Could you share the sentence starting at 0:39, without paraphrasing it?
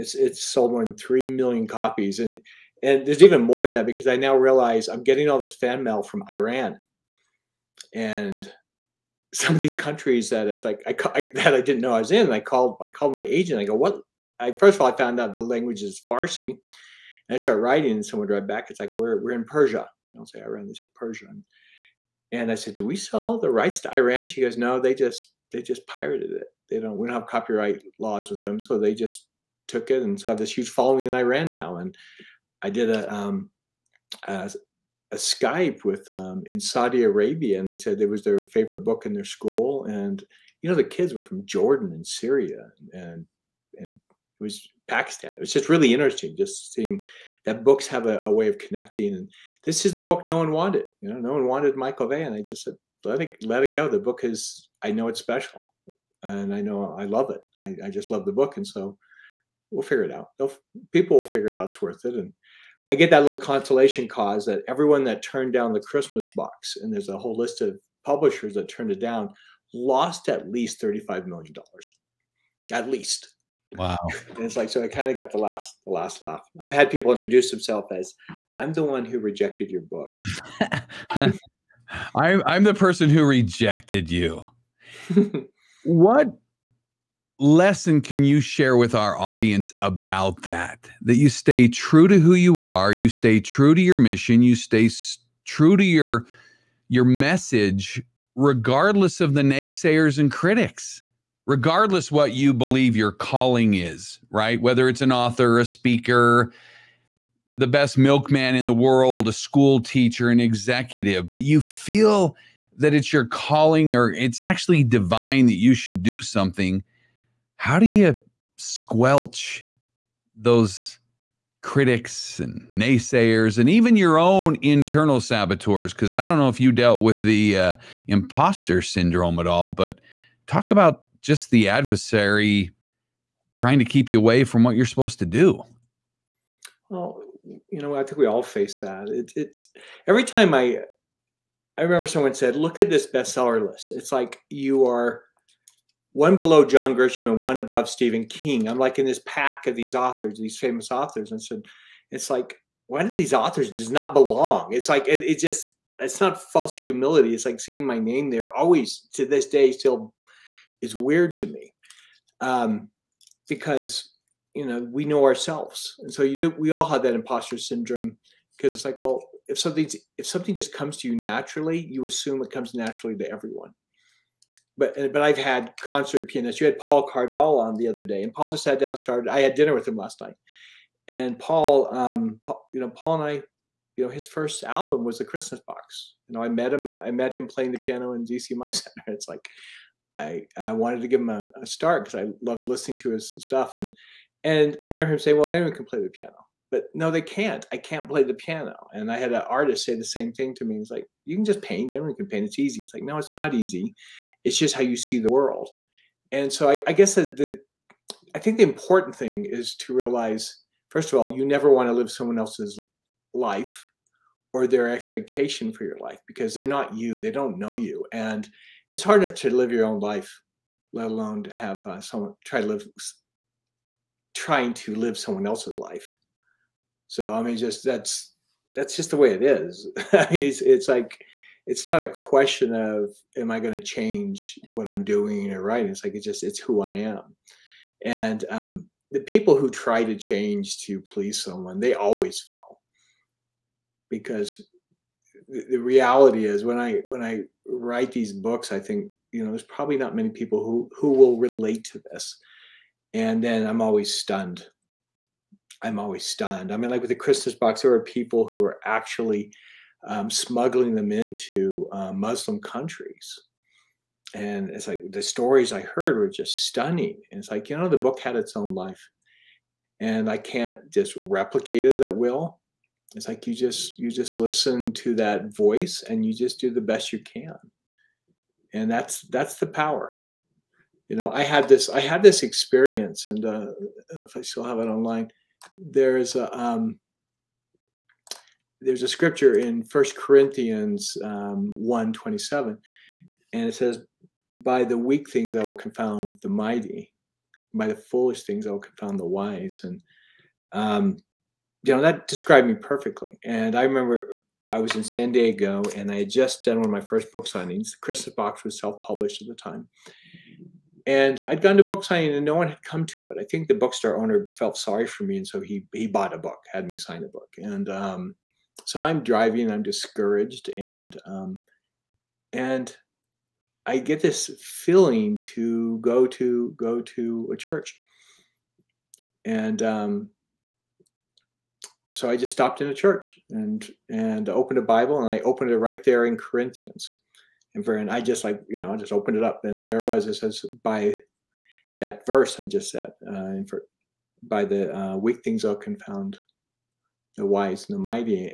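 And you know, the kids were from Jordan and Syria, and and it was Pakistan.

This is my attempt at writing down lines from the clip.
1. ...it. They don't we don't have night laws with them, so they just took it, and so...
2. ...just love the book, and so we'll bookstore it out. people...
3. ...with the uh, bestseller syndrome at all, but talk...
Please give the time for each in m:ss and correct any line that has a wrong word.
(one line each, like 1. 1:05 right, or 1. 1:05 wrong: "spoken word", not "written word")
1. 0:26 wrong: "copyright", not "night"
2. 0:57 wrong: "figure", not "bookstore"
3. 2:07 wrong: "imposter", not "bestseller".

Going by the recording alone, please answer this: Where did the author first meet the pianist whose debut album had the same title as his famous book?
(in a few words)
ZCMI Center.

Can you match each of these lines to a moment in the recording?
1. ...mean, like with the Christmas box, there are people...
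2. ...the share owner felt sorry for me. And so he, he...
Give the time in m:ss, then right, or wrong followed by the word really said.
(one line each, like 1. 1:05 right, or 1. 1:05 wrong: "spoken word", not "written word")
1. 4:16 right
2. 5:13 wrong: "bookstore", not "share".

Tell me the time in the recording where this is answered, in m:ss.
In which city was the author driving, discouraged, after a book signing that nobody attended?
5:05.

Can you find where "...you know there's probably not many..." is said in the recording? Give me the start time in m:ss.
4:09.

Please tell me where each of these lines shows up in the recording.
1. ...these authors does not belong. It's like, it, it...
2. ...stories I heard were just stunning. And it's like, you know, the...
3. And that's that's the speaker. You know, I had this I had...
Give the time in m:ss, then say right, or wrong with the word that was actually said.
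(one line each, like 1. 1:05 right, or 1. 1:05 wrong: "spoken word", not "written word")
1. 2:33 right
2. 4:25 right
3. 4:38 wrong: "power", not "speaker".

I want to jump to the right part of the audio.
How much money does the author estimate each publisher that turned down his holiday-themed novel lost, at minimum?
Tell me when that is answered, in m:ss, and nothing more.
1:10.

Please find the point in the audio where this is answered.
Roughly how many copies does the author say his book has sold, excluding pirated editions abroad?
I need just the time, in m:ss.
0:00.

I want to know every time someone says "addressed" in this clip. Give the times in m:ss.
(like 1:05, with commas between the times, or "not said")
not said.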